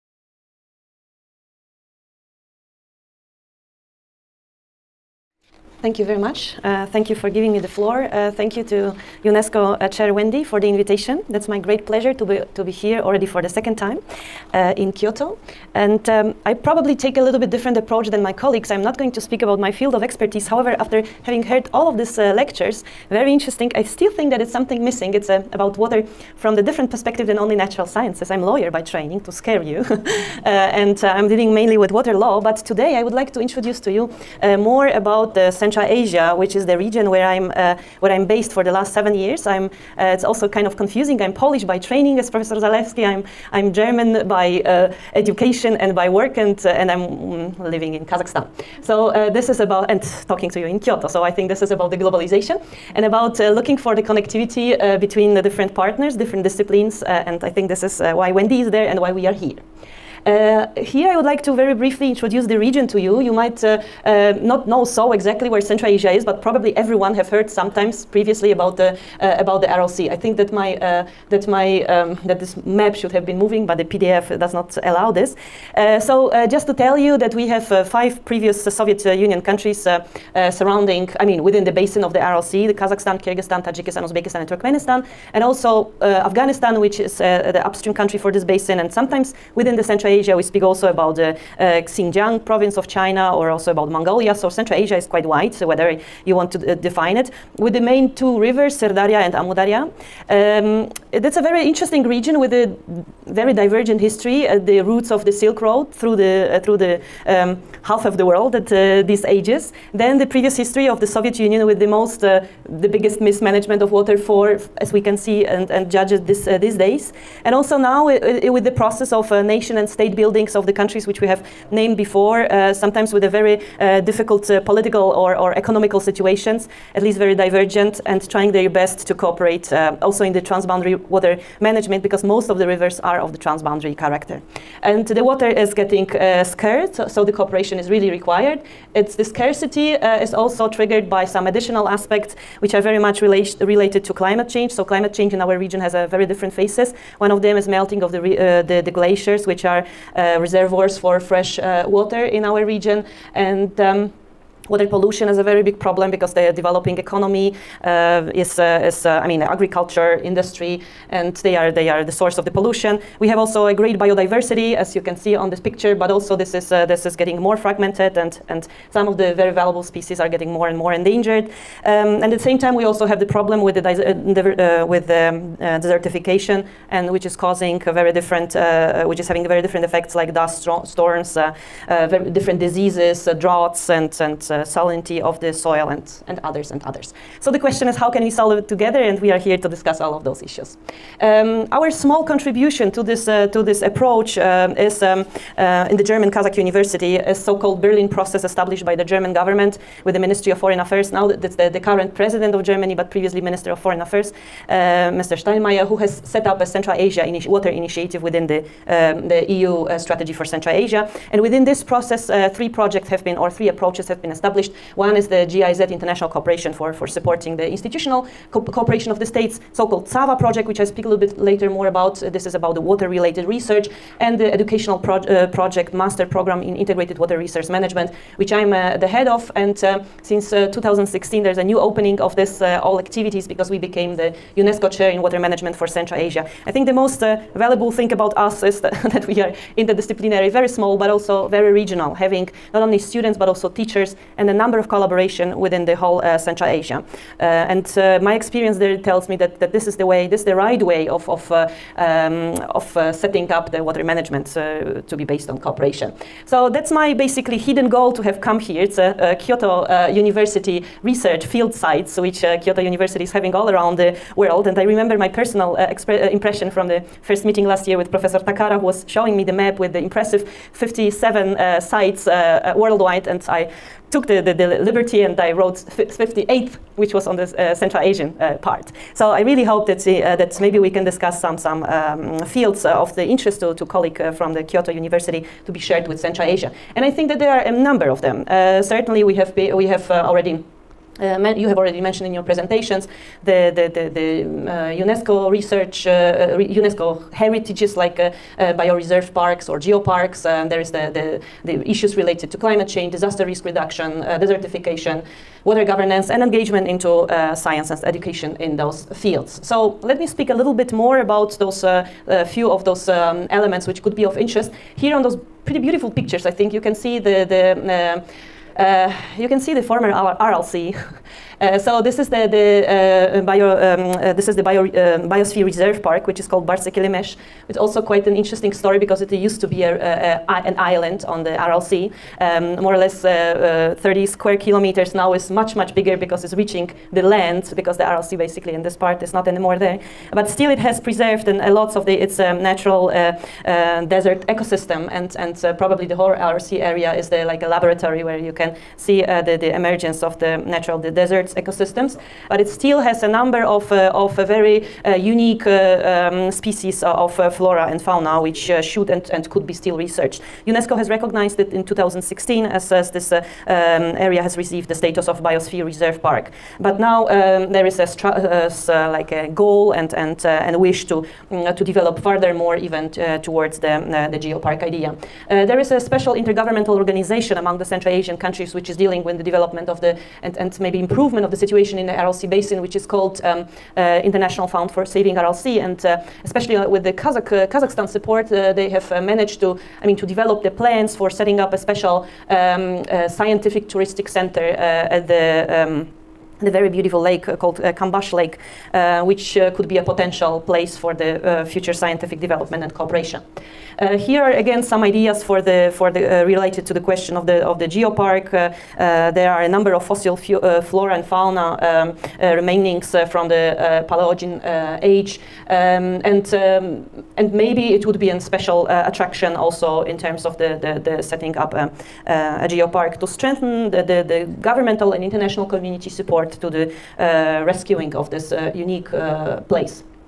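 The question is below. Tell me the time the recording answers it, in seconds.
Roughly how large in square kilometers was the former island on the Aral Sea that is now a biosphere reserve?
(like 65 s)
334 s.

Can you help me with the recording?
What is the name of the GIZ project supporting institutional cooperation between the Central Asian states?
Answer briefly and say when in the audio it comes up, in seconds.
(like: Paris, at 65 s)
CAWa, at 220 s.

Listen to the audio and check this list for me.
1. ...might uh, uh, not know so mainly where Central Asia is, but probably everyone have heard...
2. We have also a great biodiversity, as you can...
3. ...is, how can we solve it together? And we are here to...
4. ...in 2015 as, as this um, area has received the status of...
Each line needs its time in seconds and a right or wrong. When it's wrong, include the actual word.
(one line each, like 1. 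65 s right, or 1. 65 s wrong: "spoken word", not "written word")
1. 63 s wrong: "exactly", not "mainly"
2. 163 s right
3. 187 s right
4. 361 s wrong: "2016", not "2015".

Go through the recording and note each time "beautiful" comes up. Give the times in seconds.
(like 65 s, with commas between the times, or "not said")
315 s, 396 s.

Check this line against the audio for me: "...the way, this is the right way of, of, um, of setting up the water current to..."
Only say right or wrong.
wrong.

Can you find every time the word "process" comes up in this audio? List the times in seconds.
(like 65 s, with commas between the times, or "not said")
118 s, 198 s, 211 s.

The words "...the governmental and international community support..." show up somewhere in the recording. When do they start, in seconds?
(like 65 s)
424 s.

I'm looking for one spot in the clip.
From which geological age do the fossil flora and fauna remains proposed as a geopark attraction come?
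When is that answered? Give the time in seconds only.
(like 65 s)
414 s.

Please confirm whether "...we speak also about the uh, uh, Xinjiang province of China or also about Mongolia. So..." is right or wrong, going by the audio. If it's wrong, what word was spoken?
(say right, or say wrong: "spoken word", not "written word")
right.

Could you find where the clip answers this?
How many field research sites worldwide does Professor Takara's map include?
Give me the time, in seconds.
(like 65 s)
270 s.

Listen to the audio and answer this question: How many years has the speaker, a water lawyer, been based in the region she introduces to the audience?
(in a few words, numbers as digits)
7.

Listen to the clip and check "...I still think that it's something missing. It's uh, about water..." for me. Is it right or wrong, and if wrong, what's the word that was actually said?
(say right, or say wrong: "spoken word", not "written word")
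right.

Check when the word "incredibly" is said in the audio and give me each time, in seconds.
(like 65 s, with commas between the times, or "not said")
not said.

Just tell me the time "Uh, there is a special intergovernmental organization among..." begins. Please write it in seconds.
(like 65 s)
375 s.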